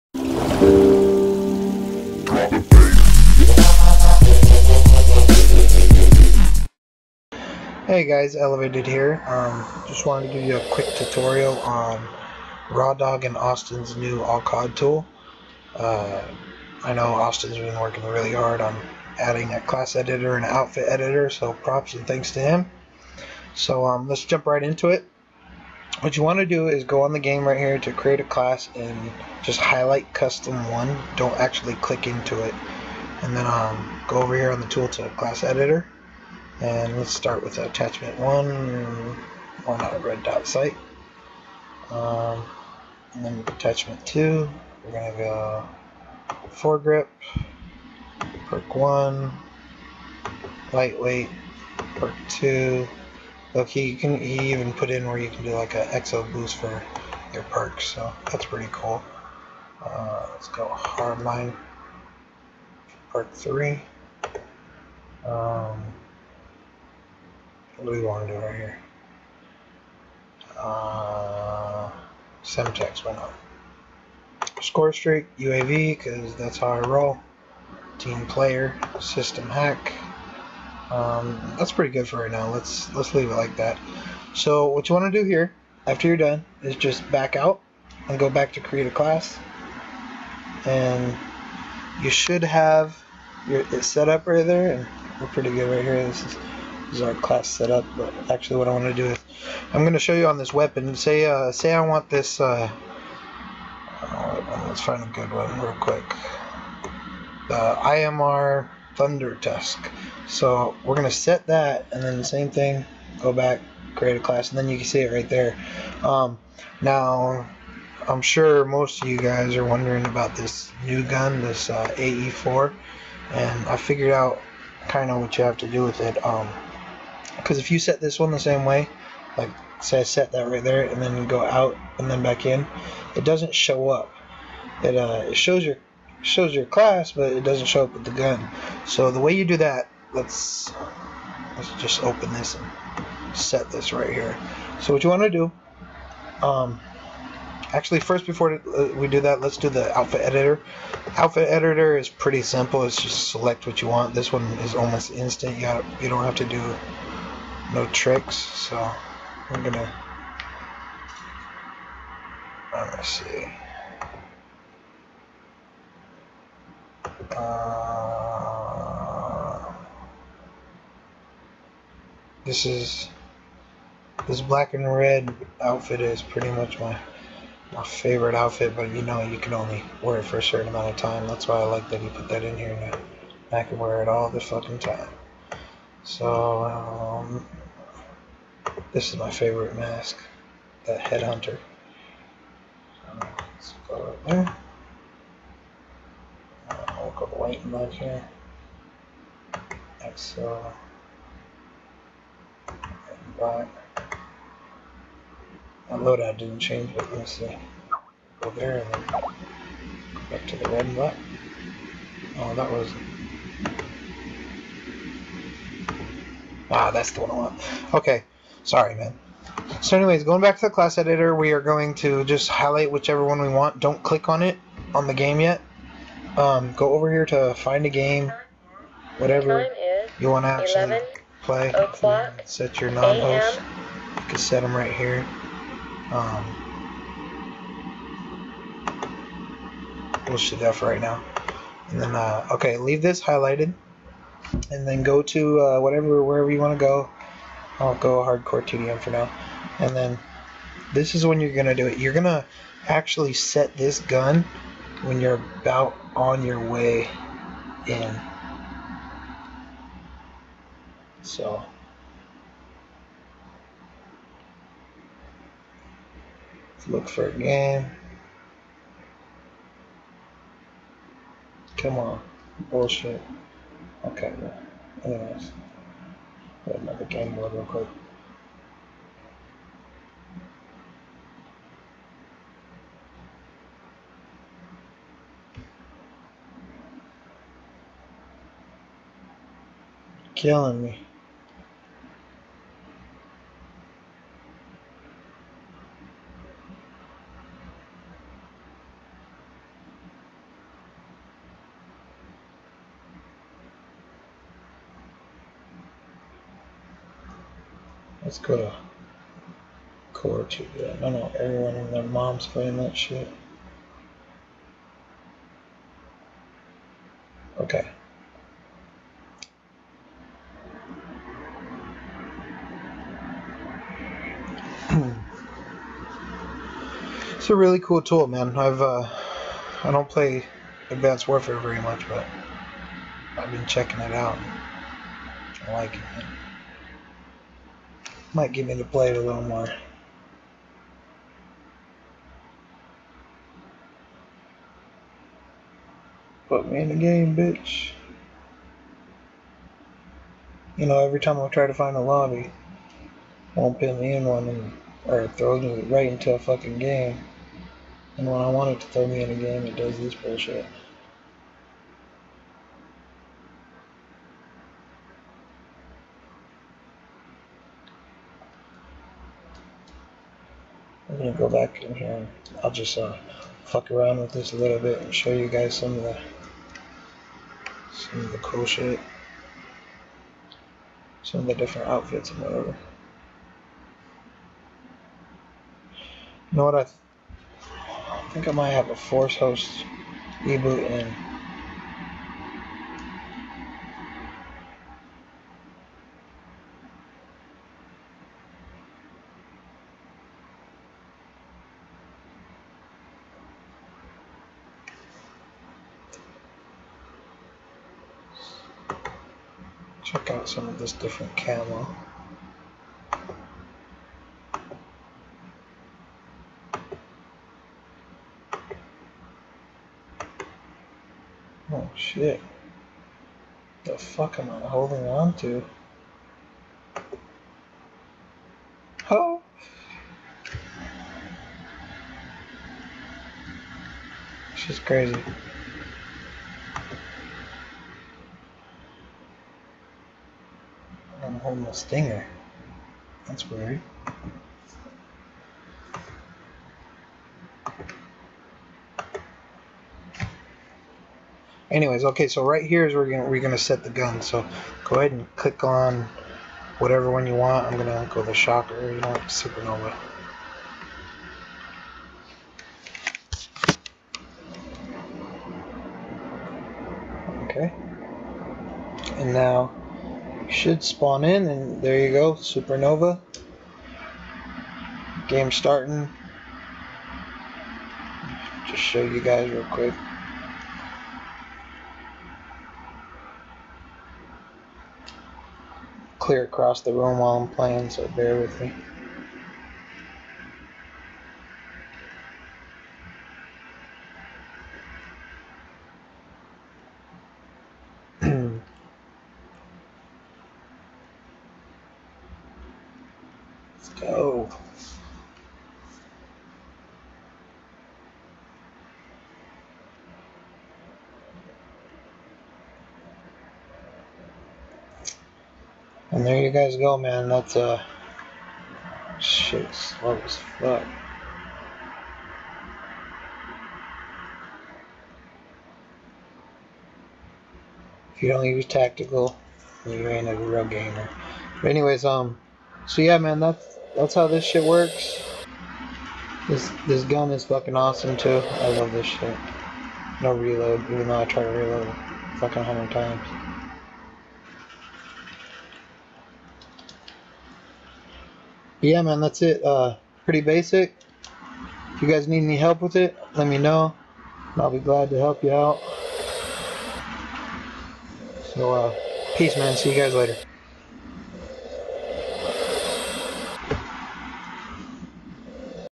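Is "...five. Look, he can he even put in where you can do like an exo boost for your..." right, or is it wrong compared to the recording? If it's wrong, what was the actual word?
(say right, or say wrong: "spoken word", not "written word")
wrong: "two", not "five".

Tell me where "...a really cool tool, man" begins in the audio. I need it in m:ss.
5:27.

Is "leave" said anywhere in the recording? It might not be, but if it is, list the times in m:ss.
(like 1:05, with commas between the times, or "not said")
1:23, 4:02.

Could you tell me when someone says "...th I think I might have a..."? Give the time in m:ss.
6:26.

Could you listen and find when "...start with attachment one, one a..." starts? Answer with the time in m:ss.
0:37.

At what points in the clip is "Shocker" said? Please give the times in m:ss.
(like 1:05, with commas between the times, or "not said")
7:38.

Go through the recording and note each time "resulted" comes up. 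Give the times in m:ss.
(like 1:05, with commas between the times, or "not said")
not said.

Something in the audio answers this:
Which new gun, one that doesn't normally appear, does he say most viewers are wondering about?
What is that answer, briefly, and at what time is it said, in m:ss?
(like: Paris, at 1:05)
AE4, at 2:01.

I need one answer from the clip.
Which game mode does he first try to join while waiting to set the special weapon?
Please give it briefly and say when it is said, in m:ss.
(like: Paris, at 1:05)
Hardcore TDM, at 4:08.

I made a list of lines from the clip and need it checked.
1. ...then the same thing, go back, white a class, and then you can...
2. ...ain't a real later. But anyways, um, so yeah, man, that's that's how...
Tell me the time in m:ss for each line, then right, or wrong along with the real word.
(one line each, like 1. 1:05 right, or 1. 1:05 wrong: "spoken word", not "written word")
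1. 1:52 wrong: "create", not "white"
2. 8:50 wrong: "gamer", not "later".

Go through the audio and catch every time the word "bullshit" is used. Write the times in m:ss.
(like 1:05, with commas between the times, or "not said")
4:32, 6:00.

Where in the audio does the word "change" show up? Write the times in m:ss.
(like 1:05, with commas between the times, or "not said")
3:26.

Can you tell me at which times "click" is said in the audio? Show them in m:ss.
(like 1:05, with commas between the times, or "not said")
0:31, 3:44, 7:35.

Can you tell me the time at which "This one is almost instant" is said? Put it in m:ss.
2:34.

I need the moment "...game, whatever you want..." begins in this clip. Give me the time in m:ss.
3:47.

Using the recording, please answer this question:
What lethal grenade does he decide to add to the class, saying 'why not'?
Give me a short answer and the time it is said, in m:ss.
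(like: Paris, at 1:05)
Semtex, at 1:12.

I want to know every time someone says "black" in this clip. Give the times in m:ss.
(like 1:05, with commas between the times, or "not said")
2:54, 3:23, 3:30.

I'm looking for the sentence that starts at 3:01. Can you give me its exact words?
That's why I like that he put that in here.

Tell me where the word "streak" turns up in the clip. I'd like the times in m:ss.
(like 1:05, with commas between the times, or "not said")
1:14.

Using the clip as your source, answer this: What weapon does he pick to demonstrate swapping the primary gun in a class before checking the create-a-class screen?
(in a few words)
IMR Thunder Tusk.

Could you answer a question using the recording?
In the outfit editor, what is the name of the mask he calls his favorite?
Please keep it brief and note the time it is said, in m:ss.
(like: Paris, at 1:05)
Headhunter, at 3:10.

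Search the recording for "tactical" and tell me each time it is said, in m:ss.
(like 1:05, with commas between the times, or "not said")
8:48.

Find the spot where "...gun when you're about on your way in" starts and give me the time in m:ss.
4:13.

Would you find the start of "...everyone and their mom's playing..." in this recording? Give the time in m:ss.
5:11.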